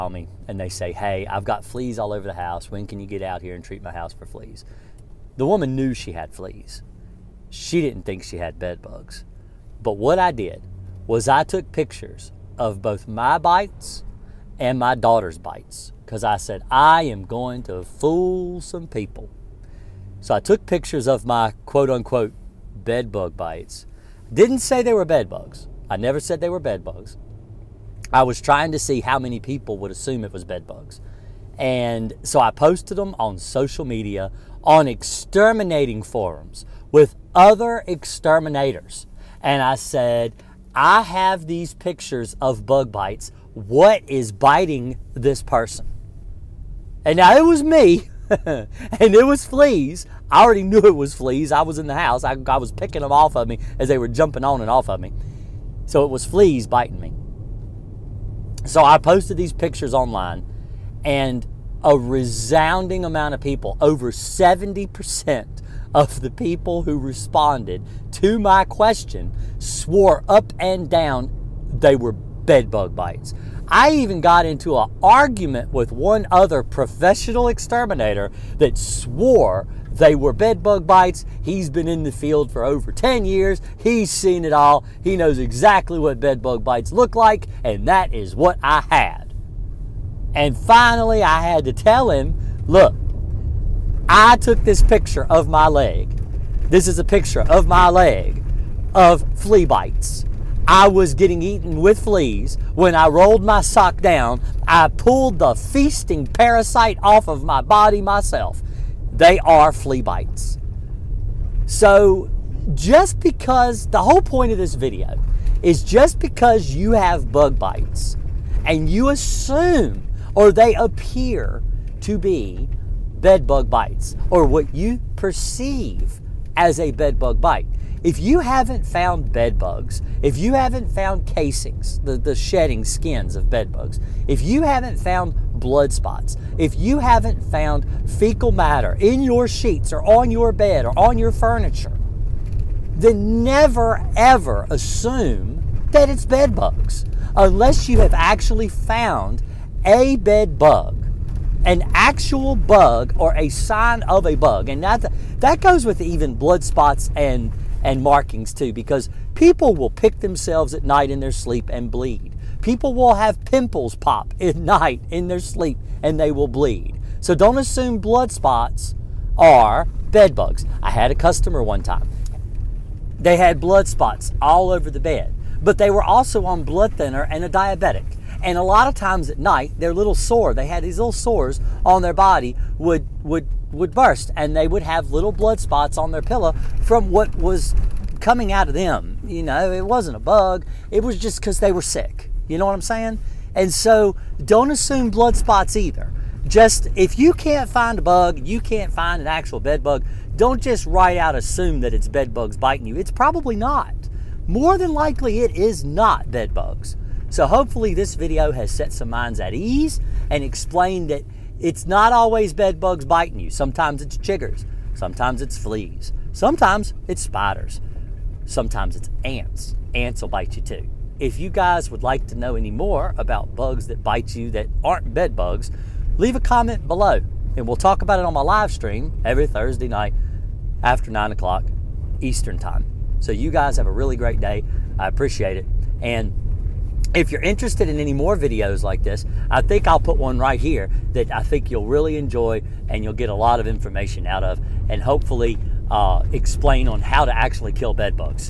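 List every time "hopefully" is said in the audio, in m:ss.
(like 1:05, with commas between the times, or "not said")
3:27, 4:05.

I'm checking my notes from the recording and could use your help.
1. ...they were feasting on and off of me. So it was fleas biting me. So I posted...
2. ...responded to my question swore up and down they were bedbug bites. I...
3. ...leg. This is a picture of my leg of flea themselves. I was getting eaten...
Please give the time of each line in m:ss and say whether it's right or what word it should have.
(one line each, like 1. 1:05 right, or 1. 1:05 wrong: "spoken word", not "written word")
1. 0:53 wrong: "jumping", not "feasting"
2. 1:06 right
3. 1:35 wrong: "bites", not "themselves".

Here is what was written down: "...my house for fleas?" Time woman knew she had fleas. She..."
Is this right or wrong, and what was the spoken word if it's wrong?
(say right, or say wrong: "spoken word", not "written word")
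wrong: "The", not "Time".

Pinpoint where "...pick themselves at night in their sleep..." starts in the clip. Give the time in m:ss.
2:39.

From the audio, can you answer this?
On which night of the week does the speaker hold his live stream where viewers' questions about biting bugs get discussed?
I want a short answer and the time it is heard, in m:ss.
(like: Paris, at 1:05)
Thursday, at 3:49.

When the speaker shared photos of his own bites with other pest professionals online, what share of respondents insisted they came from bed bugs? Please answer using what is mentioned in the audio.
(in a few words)
over 70%.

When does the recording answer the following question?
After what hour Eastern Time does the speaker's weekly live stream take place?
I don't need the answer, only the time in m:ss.
3:51.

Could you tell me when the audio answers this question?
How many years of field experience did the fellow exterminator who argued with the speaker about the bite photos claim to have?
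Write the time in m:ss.
1:22.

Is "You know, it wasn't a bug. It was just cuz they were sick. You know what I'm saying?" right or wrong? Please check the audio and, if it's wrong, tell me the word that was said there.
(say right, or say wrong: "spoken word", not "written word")
right.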